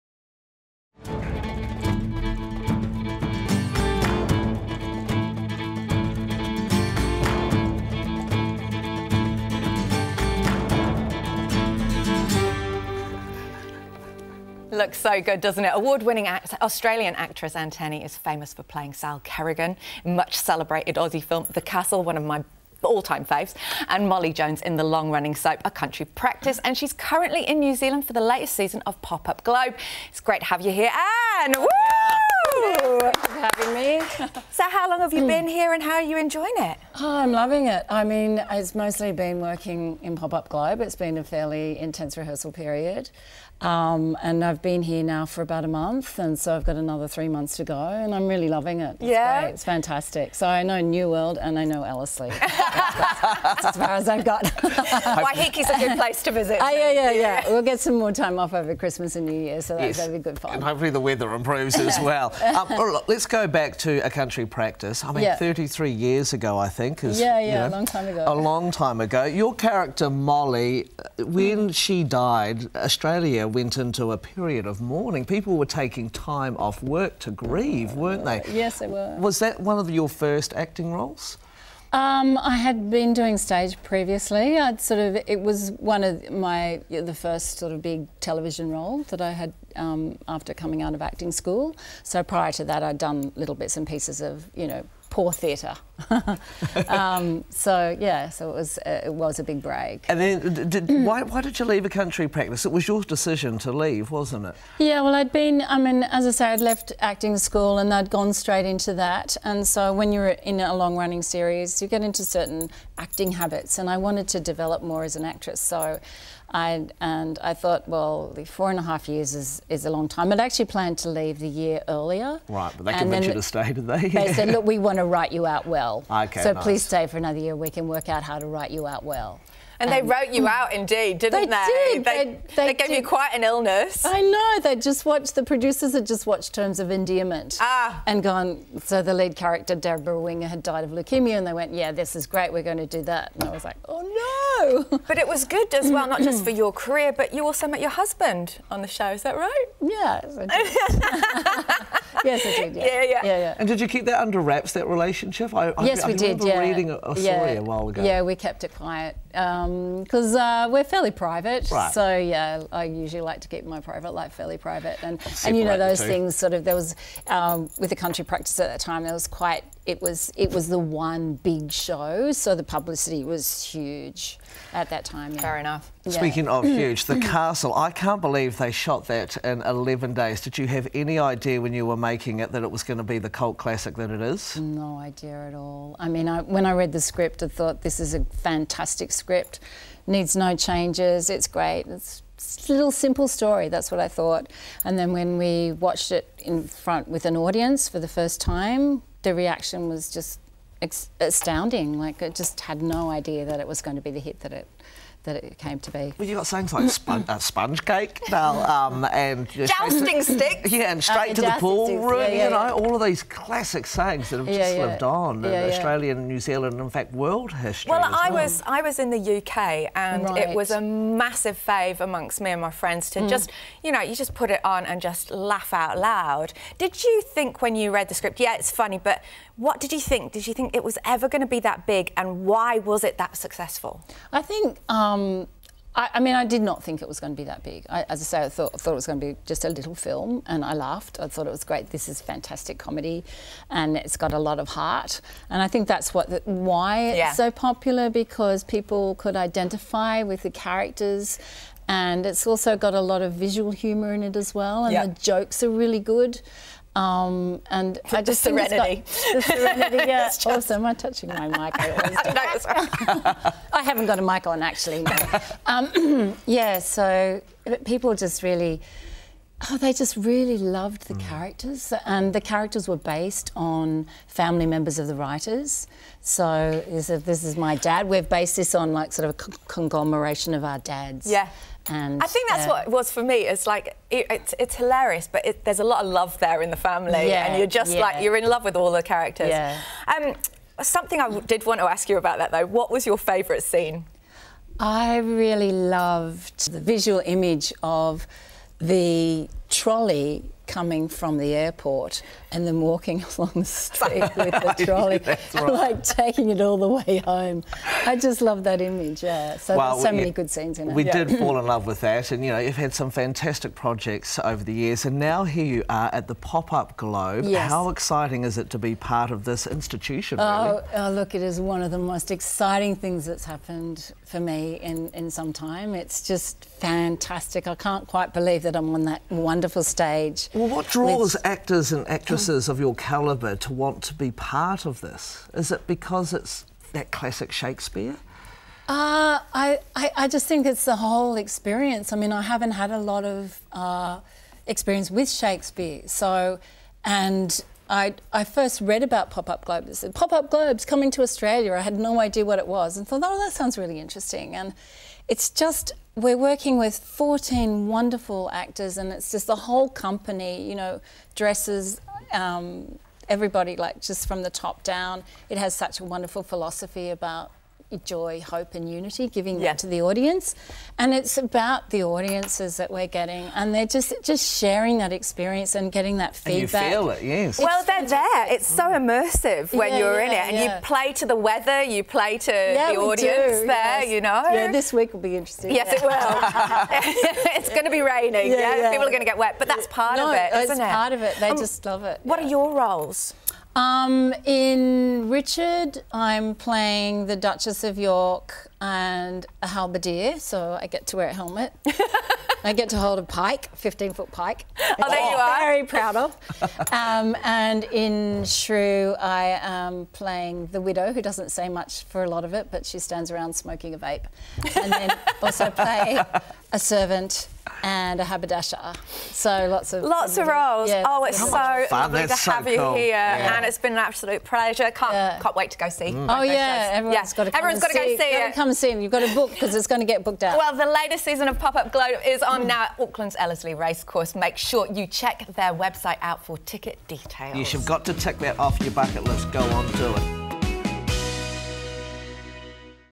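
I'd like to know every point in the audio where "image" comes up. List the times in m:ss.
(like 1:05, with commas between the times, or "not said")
4:57, 5:08.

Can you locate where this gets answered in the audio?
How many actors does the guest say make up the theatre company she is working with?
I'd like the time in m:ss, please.
5:56.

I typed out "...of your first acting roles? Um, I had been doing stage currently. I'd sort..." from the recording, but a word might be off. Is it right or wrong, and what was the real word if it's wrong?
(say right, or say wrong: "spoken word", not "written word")
wrong: "previously", not "currently".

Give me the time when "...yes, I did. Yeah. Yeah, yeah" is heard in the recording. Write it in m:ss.
2:32.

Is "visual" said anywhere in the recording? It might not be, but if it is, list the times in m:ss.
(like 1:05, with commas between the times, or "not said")
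4:13, 4:56.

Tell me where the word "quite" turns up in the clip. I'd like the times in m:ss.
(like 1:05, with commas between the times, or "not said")
2:13, 2:49, 5:28.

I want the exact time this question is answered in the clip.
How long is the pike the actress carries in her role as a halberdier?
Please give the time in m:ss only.
6:43.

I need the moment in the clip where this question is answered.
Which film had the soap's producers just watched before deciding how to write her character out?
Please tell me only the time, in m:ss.
2:16.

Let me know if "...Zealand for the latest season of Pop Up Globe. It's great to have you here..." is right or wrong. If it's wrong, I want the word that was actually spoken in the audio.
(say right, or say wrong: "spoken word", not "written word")
right.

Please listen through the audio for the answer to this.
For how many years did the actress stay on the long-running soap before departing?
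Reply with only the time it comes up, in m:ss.
1:58.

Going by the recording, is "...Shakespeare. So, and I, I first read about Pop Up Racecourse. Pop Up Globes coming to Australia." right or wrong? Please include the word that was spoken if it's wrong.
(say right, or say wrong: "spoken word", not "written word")
wrong: "Globes", not "Racecourse".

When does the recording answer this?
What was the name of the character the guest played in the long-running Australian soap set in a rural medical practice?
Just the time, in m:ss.
0:24.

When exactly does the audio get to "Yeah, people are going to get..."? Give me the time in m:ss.
6:28.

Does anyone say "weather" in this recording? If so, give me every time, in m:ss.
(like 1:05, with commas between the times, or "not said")
1:00, 6:21.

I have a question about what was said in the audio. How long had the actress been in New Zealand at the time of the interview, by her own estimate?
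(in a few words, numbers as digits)
About a month.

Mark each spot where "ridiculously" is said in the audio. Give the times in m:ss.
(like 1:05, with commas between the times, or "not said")
not said.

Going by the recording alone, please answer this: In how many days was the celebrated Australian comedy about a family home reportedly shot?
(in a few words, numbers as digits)
11 days.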